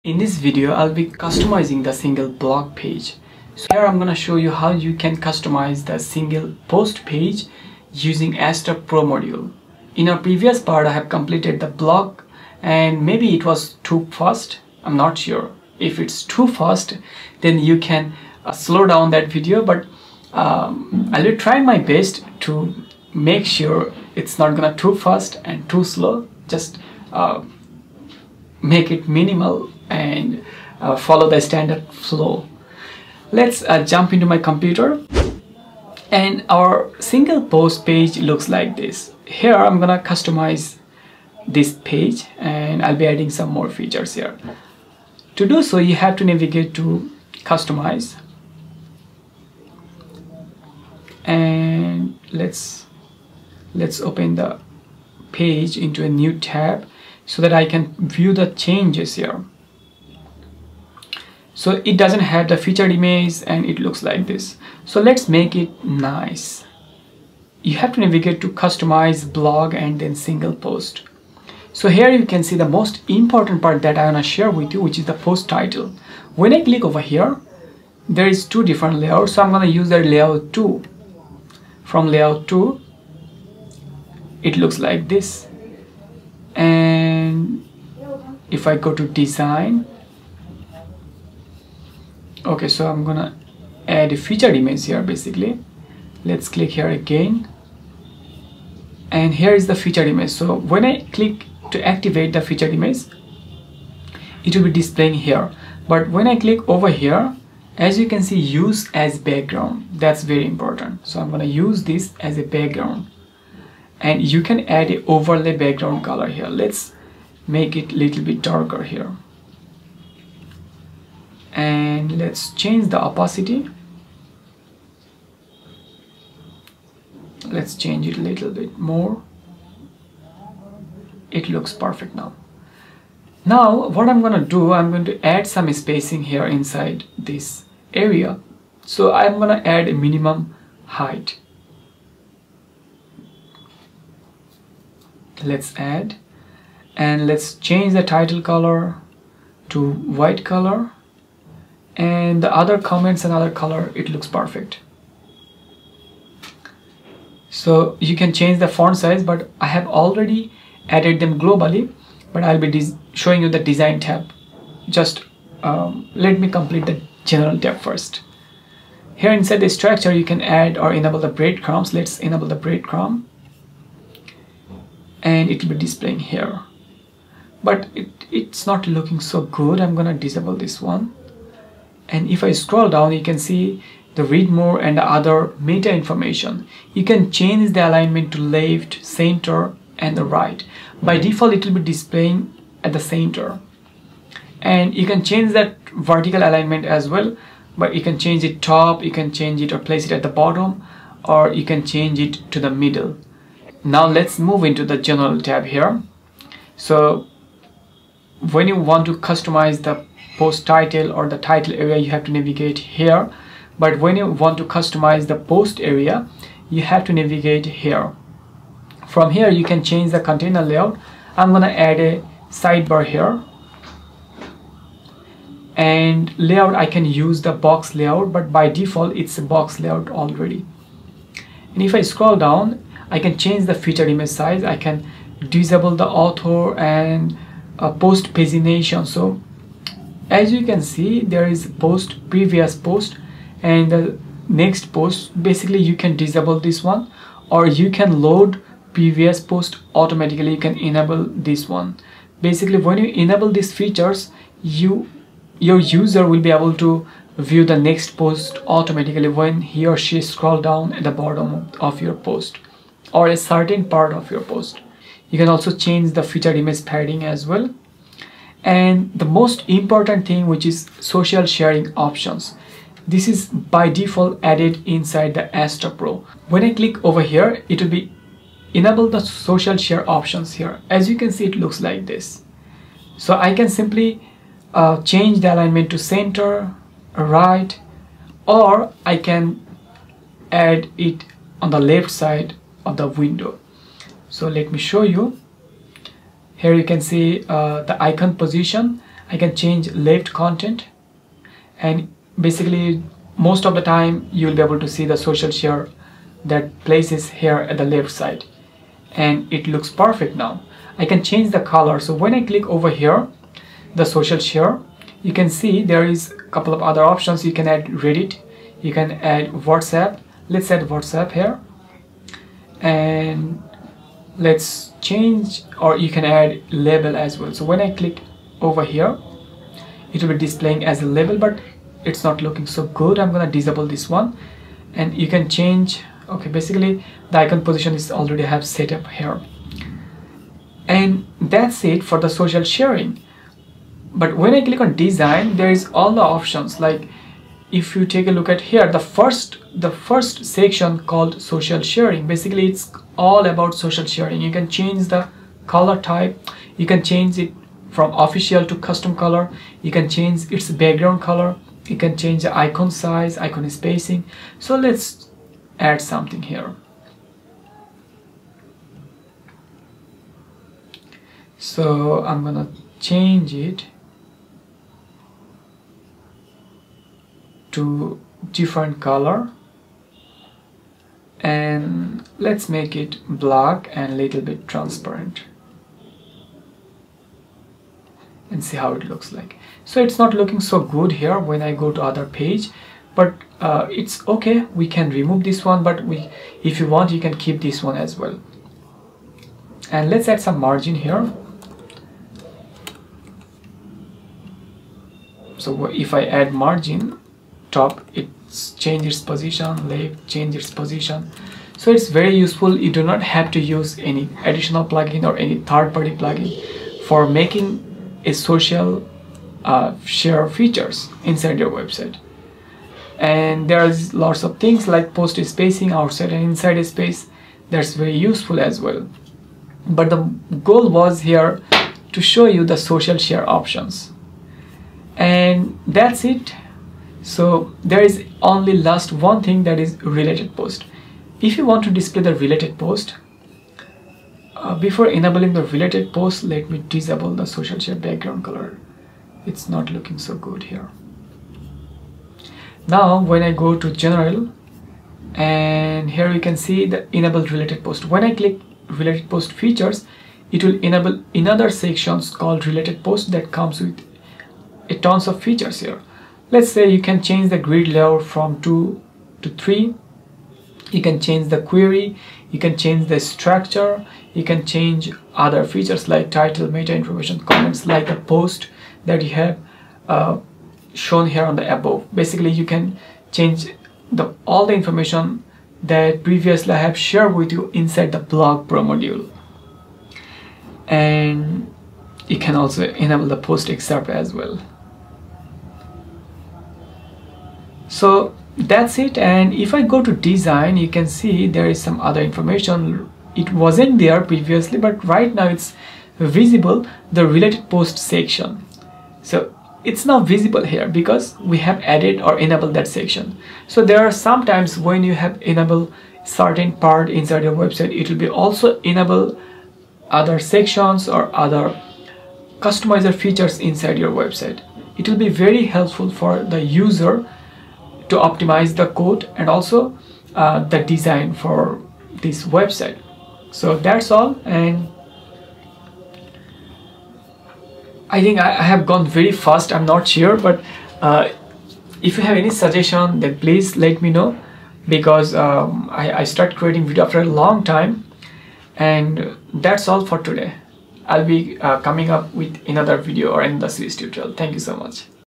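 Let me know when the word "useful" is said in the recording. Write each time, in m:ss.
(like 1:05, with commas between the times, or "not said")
6:52, 7:08.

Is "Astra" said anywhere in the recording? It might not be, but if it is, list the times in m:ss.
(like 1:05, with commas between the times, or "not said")
0:08, 4:35.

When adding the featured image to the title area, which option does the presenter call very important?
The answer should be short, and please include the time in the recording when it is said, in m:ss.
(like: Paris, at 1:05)
use as background, at 1:48.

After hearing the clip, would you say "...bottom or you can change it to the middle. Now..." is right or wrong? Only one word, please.
right.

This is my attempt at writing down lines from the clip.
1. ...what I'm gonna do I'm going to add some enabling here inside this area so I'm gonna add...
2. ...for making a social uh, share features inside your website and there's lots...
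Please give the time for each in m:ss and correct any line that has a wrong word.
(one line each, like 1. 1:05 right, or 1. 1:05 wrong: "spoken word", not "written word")
1. 2:13 wrong: "spacing", not "enabling"
2. 6:57 right.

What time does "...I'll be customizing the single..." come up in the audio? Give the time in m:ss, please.
0:00.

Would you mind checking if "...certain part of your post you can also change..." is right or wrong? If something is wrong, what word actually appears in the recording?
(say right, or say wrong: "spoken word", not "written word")
right.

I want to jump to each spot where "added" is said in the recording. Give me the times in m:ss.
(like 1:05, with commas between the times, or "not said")
2:40, 4:34, 8:31.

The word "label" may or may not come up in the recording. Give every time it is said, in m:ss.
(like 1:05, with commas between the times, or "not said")
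5:26, 5:31.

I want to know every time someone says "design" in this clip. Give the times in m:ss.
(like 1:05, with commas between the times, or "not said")
1:29, 2:43, 5:44, 8:20, 8:50.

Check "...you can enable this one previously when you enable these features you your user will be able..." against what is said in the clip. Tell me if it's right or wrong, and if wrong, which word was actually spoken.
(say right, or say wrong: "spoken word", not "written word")
wrong: "basically", not "previously".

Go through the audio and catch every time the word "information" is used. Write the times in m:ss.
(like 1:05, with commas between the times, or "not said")
3:05, 7:56, 8:04, 8:22.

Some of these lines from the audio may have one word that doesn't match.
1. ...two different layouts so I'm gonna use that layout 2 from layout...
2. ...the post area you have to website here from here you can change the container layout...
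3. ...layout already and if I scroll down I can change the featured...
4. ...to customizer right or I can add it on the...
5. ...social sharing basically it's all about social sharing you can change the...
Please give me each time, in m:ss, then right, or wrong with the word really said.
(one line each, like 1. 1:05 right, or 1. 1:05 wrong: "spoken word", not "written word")
1. 1:18 right
2. 3:35 wrong: "navigate", not "website"
3. 3:49 right
4. 4:45 wrong: "center", not "customizer"
5. 5:51 right.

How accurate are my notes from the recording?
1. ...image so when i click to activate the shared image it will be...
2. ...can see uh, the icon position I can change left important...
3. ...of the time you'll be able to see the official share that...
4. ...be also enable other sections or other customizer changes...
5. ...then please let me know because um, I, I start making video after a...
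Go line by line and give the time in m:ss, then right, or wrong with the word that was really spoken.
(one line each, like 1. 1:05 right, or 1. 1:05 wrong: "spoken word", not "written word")
1. 1:40 wrong: "featured", not "shared"
2. 4:56 wrong: "content", not "important"
3. 5:03 wrong: "social", not "official"
4. 8:38 wrong: "features", not "changes"
5. 9:03 wrong: "creating", not "making".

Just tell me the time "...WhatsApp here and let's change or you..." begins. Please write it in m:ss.
5:20.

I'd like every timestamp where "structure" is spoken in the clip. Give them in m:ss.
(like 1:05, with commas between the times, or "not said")
2:49, 7:53.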